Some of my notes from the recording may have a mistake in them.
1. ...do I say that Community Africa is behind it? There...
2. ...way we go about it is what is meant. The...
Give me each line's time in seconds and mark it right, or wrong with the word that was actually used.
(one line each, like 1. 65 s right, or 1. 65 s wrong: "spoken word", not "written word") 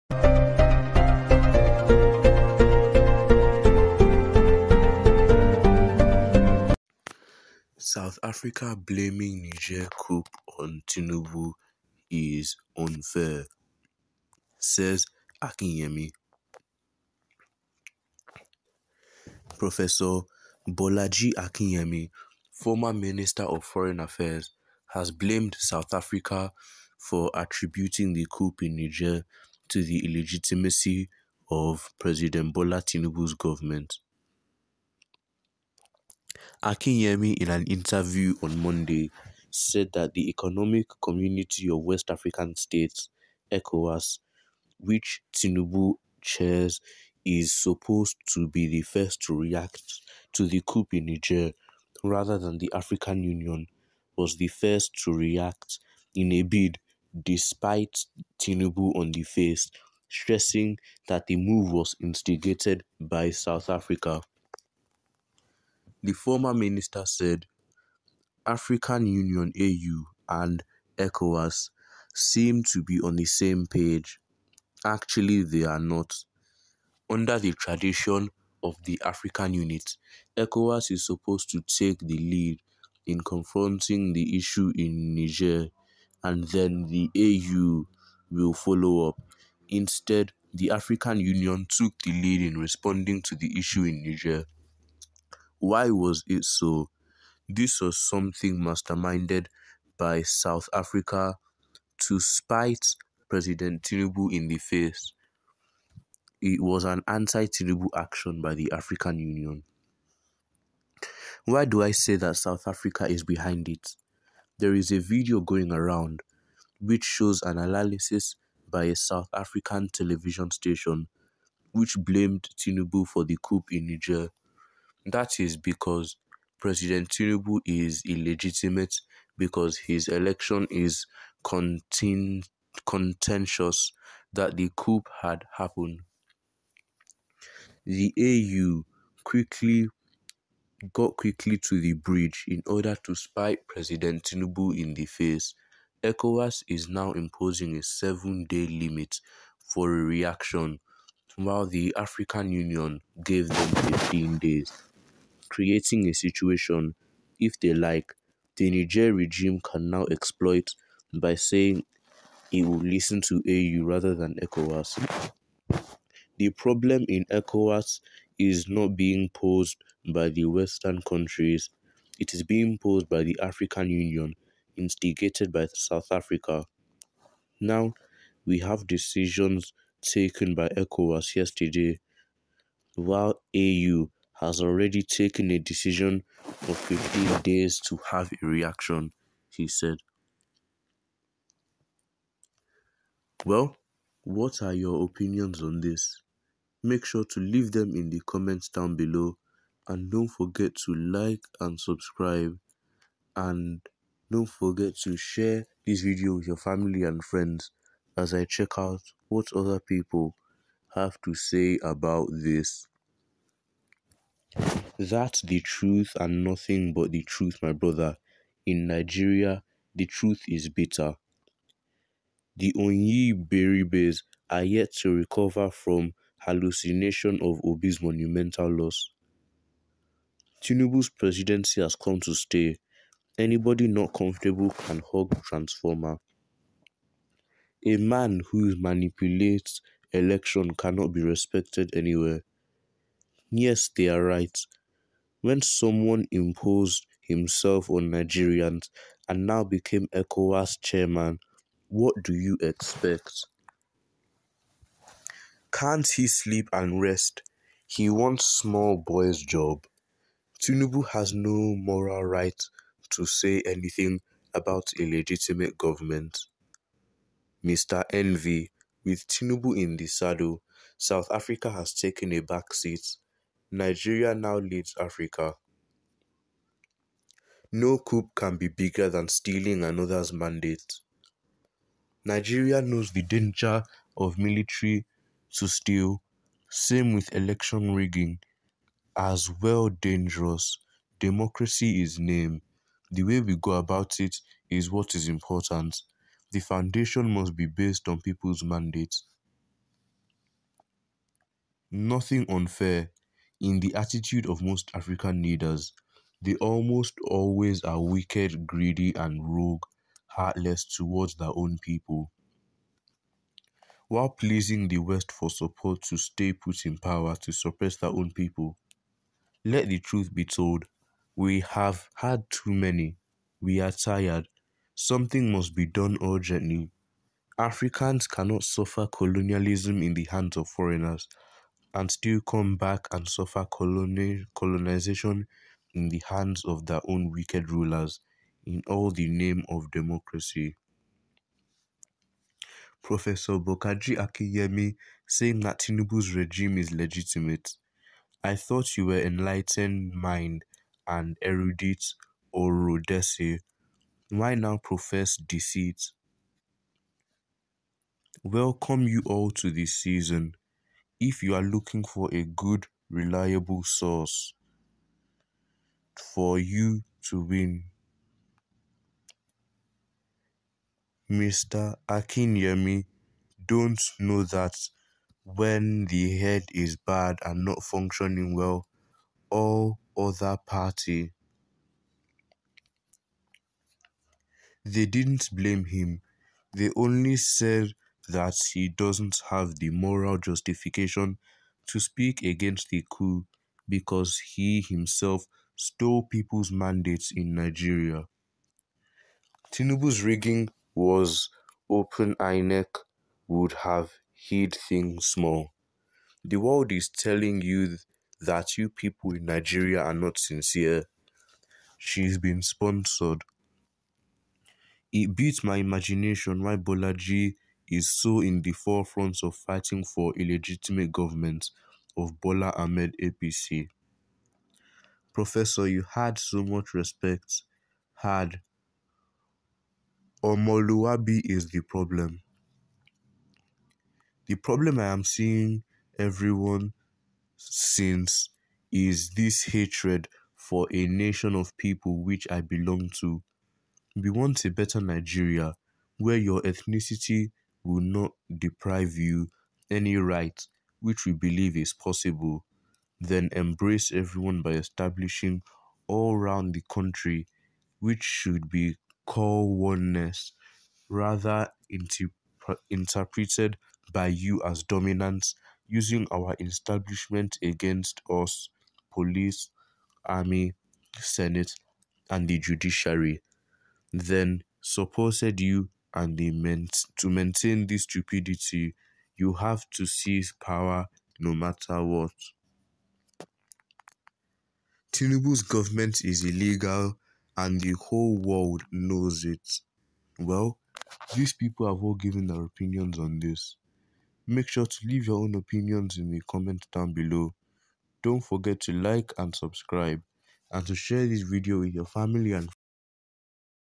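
1. 111 s wrong: "South", not "Community"
2. 293 s wrong: "important", not "meant".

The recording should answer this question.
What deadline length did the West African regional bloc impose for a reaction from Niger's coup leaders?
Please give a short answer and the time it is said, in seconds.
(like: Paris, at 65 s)
7 days, at 147 s.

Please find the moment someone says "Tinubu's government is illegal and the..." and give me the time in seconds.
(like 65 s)
485 s.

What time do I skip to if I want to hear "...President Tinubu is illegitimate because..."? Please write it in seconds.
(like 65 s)
126 s.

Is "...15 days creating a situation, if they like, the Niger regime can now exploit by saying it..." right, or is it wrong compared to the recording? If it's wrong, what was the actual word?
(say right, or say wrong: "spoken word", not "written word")
right.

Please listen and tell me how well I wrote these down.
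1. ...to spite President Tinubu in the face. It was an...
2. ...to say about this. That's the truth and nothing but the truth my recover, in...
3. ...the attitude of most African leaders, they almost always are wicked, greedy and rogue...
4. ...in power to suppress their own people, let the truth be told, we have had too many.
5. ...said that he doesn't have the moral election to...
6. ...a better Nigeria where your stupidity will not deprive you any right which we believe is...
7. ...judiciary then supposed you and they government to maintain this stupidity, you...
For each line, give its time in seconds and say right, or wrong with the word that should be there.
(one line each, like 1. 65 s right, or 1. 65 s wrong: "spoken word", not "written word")
1. 102 s right
2. 211 s wrong: "brother", not "recover"
3. 303 s right
4. 316 s right
5. 387 s wrong: "justification", not "election"
6. 444 s wrong: "ethnicity", not "stupidity"
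7. 472 s wrong: "meant", not "government".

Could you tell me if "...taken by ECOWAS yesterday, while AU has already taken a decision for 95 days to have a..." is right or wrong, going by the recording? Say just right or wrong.
wrong.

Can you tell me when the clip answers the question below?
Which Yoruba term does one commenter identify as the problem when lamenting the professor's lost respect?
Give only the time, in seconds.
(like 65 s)
430 s.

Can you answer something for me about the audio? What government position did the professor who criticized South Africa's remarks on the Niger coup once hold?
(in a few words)
Minister of Foreign Affairs.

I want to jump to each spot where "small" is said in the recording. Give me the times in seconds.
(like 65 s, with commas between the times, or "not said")
258 s, 405 s.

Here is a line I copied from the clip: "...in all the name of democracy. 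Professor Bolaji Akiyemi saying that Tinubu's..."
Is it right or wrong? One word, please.
wrong.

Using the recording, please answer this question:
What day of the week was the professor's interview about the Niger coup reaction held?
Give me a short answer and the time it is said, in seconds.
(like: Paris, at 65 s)
Monday, at 38 s.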